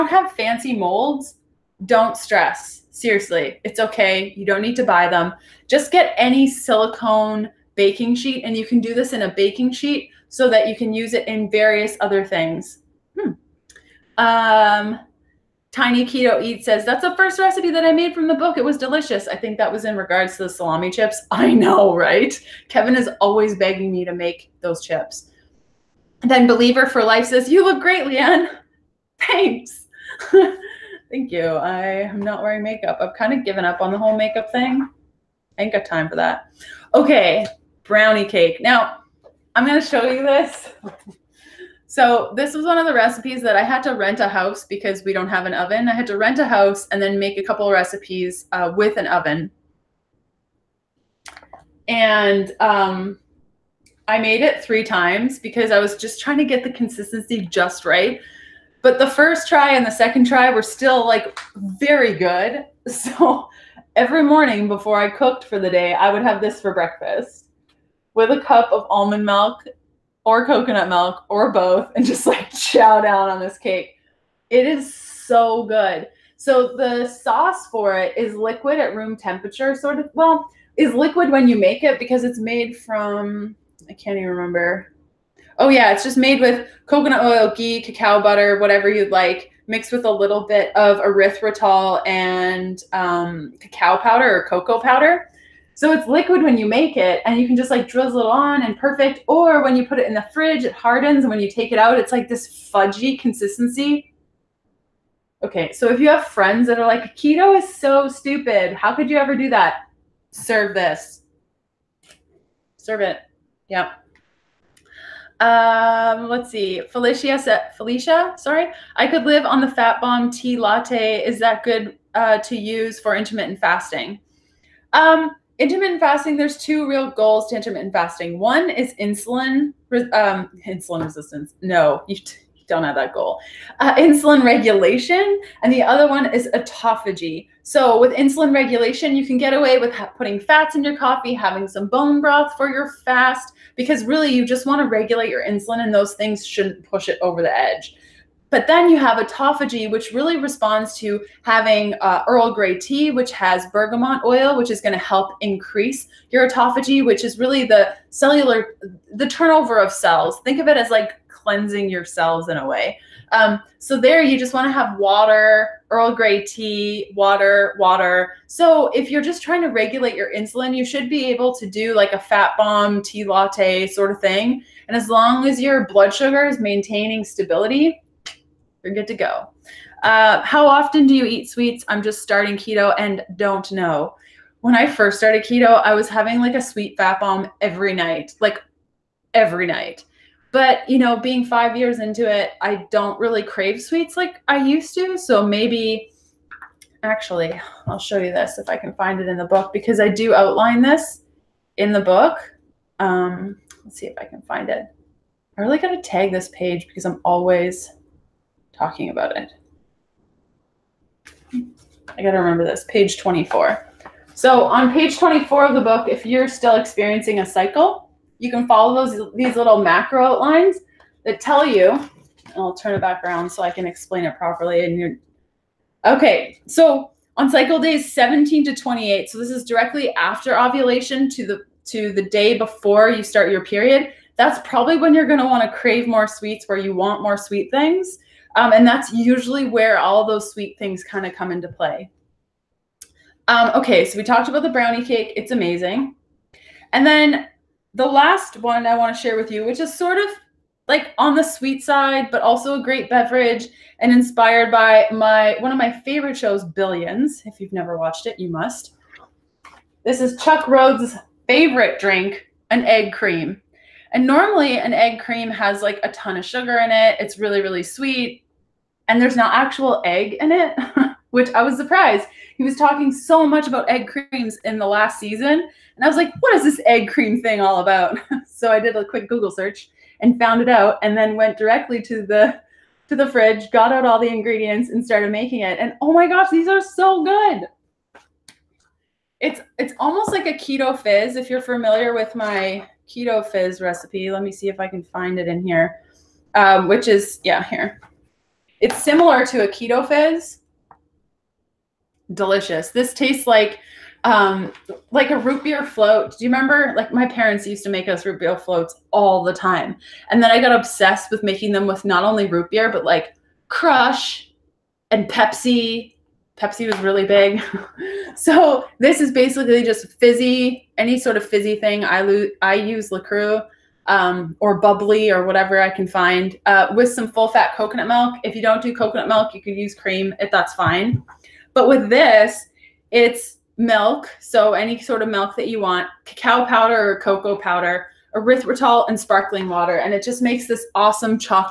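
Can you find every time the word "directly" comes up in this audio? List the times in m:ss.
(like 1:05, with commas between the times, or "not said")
3:49, 4:41.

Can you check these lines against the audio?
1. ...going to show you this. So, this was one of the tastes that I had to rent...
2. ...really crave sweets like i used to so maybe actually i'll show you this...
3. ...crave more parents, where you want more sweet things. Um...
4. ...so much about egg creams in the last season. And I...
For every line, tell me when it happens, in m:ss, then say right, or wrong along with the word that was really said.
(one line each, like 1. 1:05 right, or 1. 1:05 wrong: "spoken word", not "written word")
1. 0:39 wrong: "recipes", not "tastes"
2. 3:13 right
3. 3:55 wrong: "sweets", not "parents"
4. 4:33 right.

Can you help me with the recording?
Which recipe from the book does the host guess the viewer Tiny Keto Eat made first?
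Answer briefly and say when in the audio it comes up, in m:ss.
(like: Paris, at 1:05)
salami chips, at 0:20.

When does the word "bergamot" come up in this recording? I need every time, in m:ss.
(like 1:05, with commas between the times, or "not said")
2:33.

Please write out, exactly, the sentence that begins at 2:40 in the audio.
Think of it as like cleansing your cells in a way.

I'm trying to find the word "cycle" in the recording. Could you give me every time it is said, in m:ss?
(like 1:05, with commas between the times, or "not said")
3:37, 3:47.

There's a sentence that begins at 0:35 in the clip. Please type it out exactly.
I ain't got time for that.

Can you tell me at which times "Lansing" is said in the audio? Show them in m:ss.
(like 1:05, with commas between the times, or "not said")
not said.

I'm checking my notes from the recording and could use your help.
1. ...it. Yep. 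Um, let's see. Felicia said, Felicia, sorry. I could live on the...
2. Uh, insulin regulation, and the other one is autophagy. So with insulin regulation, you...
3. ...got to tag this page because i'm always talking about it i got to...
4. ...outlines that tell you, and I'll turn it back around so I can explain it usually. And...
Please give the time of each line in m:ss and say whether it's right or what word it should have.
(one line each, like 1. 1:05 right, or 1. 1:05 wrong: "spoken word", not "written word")
1. 1:53 right
2. 2:13 right
3. 3:25 right
4. 3:40 wrong: "properly", not "usually".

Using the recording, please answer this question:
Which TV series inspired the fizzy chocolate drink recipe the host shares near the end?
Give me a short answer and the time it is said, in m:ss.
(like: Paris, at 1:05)
Billions, at 4:16.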